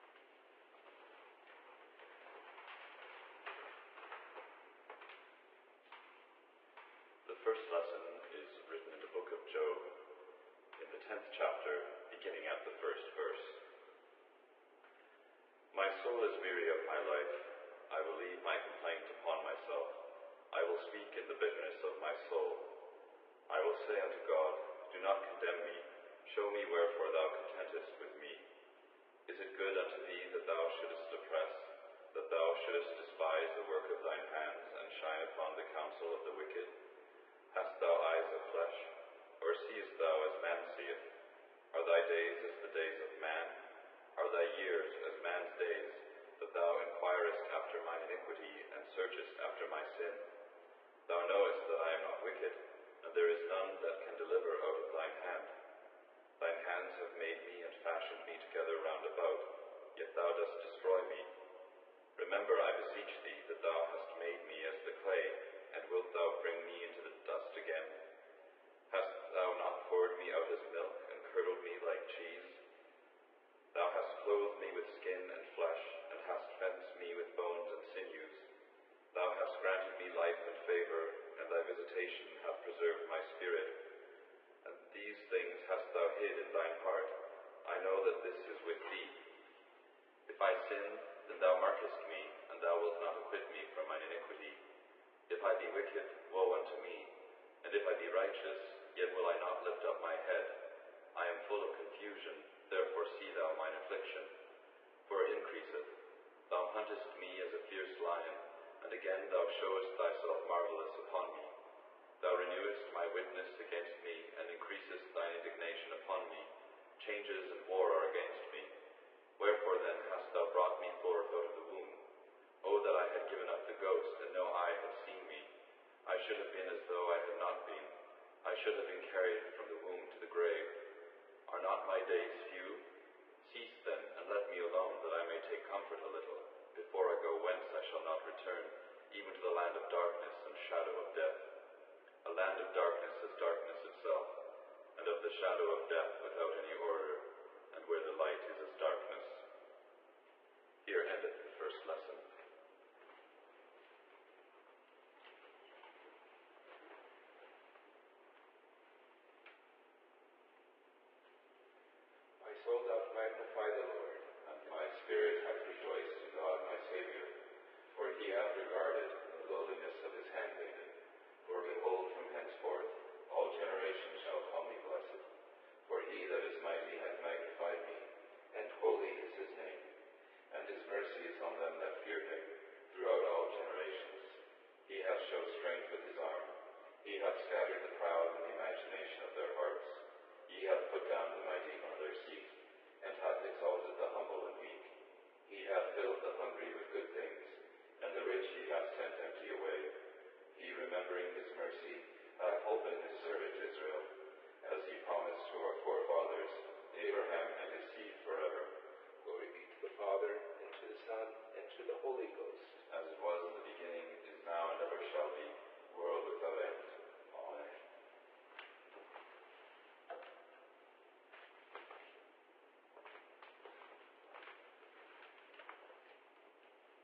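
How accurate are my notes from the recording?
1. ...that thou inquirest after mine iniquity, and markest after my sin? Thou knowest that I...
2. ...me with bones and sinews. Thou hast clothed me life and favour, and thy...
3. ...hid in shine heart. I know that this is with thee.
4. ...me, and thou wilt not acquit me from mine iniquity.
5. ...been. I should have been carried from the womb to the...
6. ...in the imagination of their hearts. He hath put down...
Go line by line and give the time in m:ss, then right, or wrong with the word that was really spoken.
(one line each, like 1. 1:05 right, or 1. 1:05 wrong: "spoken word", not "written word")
1. 0:46 wrong: "searchest", not "markest"
2. 1:16 wrong: "granted", not "clothed"
3. 1:26 wrong: "thine", not "shine"
4. 1:32 right
5. 2:07 right
6. 3:08 right.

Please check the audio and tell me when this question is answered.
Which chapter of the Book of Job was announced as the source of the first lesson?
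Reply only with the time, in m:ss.
0:10.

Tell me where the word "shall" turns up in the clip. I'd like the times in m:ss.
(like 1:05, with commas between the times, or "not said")
2:17, 2:54, 3:35.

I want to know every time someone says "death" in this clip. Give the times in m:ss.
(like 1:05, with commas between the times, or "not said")
2:21, 2:25.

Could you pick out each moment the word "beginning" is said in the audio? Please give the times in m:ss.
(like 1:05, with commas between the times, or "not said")
0:12, 3:33.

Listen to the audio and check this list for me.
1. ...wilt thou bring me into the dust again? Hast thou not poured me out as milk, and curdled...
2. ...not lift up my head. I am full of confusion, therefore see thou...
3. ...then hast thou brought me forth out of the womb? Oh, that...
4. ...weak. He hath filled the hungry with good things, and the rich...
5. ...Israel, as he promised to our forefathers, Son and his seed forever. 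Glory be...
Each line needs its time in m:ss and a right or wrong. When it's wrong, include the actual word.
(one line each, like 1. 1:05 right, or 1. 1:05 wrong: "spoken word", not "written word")
1. 1:05 right
2. 1:39 right
3. 1:59 right
4. 3:14 right
5. 3:23 wrong: "Abraham", not "Son".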